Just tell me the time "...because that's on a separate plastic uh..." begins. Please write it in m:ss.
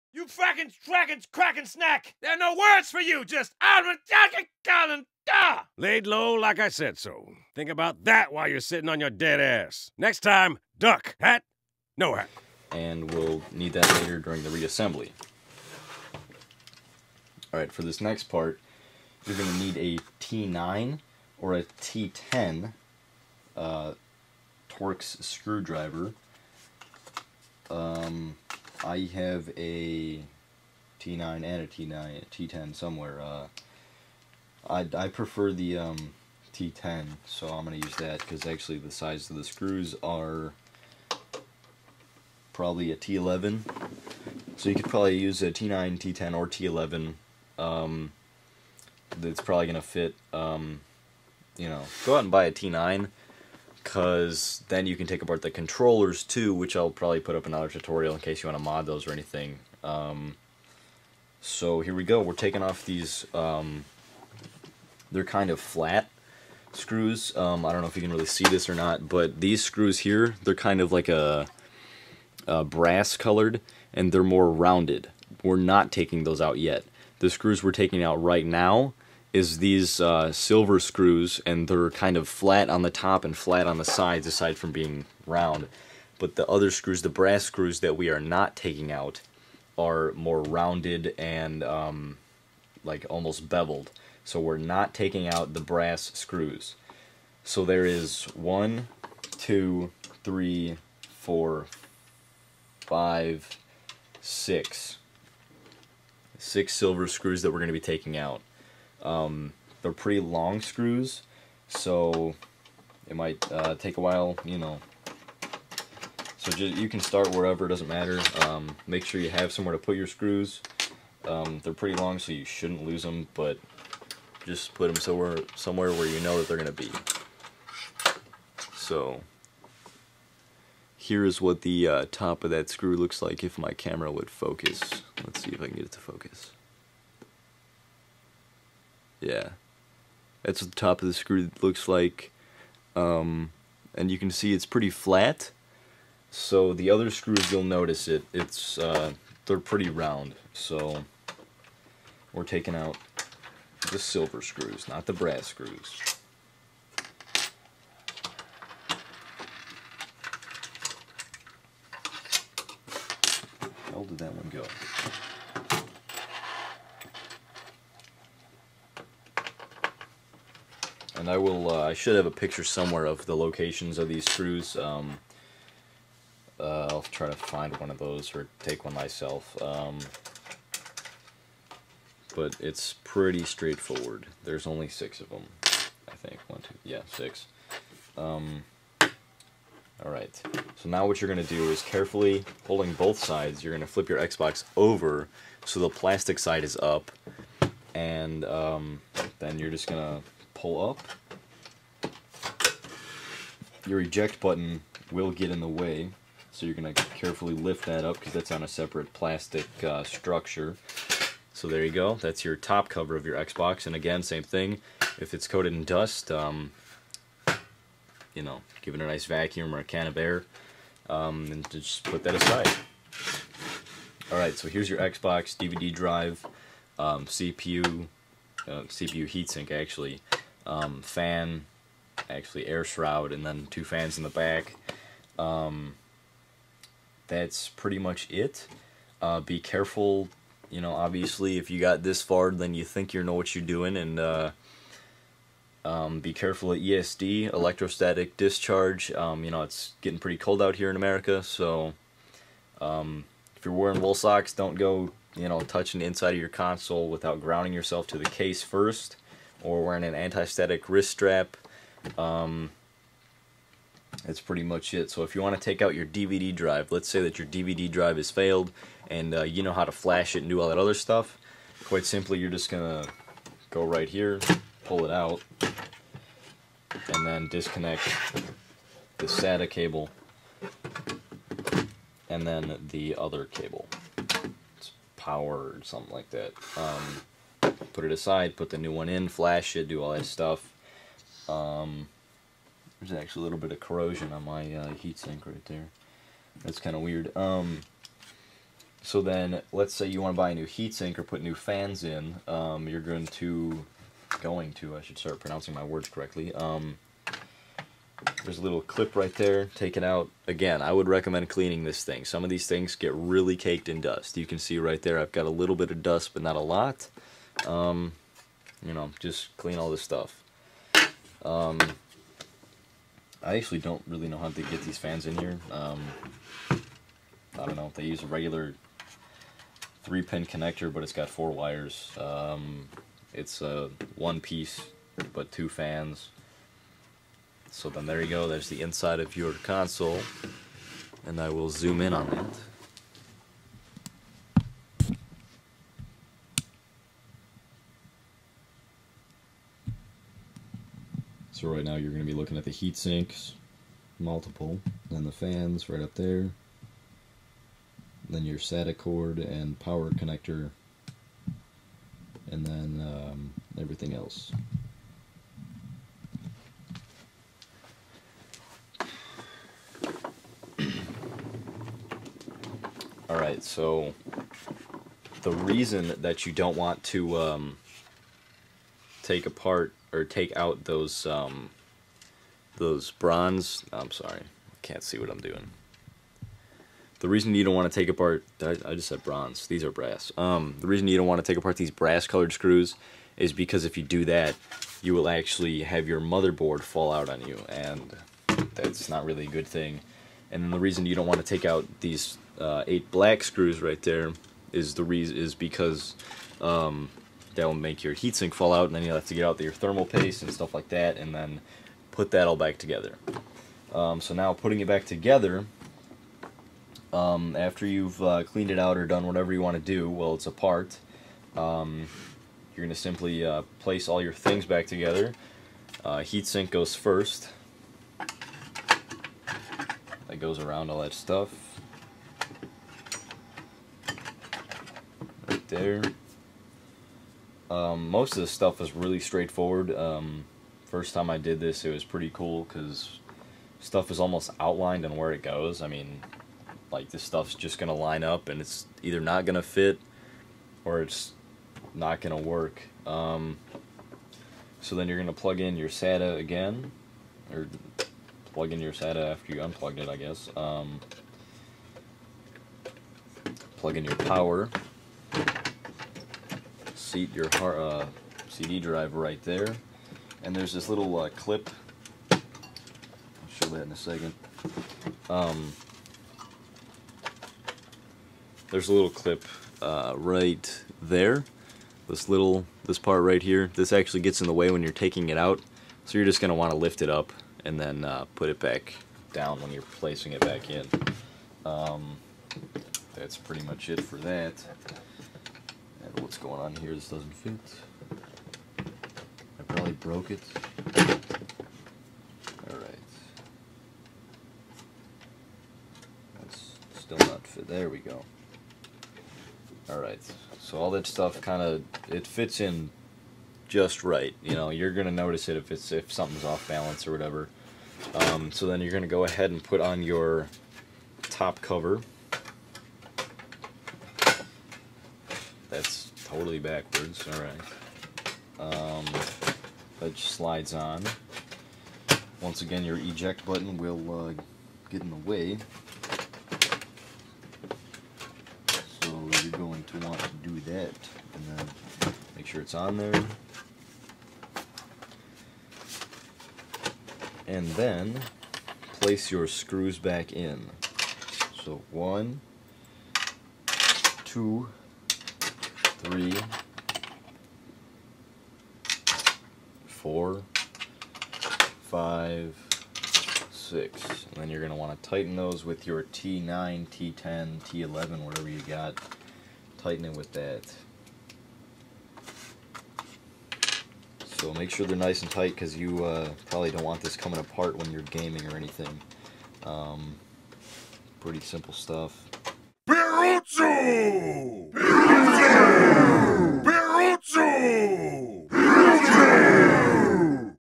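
3:28.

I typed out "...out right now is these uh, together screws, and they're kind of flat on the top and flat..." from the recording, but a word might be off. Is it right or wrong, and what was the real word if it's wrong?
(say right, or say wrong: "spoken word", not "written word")
wrong: "silver", not "together".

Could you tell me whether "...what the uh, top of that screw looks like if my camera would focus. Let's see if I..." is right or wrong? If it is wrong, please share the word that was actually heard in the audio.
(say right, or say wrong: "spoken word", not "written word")
right.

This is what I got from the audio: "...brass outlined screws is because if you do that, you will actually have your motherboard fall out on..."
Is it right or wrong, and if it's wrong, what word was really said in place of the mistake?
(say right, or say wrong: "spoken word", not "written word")
wrong: "colored", not "outlined".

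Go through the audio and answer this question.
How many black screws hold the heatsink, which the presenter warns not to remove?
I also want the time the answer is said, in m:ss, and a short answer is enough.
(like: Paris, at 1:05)
8, at 6:42.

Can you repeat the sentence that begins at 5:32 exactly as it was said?
Um, it's a one piece, but two fans.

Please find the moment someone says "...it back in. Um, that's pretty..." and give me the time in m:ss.
8:10.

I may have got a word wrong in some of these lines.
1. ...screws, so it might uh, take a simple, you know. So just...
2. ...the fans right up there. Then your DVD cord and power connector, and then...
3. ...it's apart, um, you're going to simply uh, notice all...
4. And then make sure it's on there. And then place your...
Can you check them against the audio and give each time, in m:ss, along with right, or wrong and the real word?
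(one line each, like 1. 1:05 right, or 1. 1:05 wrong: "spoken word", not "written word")
1. 1:50 wrong: "while", not "simple"
2. 5:55 wrong: "SATA", not "DVD"
3. 7:00 wrong: "place", not "notice"
4. 9:01 right.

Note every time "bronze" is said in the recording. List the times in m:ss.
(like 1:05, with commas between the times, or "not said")
6:23, 6:29.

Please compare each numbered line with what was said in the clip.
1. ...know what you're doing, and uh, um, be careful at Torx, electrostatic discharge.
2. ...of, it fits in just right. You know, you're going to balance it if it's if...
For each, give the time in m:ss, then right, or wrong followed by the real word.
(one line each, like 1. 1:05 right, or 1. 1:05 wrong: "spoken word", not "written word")
1. 4:03 wrong: "ESD", not "Torx"
2. 8:31 wrong: "notice", not "balance".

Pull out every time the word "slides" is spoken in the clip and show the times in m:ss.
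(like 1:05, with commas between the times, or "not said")
8:50.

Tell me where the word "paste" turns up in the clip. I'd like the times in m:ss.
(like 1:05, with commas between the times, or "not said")
6:50.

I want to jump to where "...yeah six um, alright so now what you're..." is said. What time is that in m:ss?
3:06.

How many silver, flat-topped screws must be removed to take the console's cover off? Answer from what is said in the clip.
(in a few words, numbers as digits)
6.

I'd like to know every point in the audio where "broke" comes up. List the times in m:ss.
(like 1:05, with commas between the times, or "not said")
8:19.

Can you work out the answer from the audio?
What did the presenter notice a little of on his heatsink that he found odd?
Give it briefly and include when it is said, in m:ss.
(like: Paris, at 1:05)
corrosion, at 4:53.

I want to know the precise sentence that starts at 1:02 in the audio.
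We're taking off these, um, they're kind of flat screws.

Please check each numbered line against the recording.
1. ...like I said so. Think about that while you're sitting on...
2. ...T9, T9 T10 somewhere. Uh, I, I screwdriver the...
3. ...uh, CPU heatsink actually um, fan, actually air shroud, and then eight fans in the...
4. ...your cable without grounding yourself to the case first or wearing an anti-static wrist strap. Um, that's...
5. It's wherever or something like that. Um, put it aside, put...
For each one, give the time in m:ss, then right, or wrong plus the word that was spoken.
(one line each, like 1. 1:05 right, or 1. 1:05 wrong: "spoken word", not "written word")
1. 0:06 right
2. 0:31 wrong: "prefer", not "screwdriver"
3. 3:48 wrong: "two", not "eight"
4. 4:16 wrong: "console", not "cable"
5. 4:44 wrong: "power", not "wherever".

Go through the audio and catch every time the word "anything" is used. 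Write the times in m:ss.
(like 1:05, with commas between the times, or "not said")
0:59, 9:38.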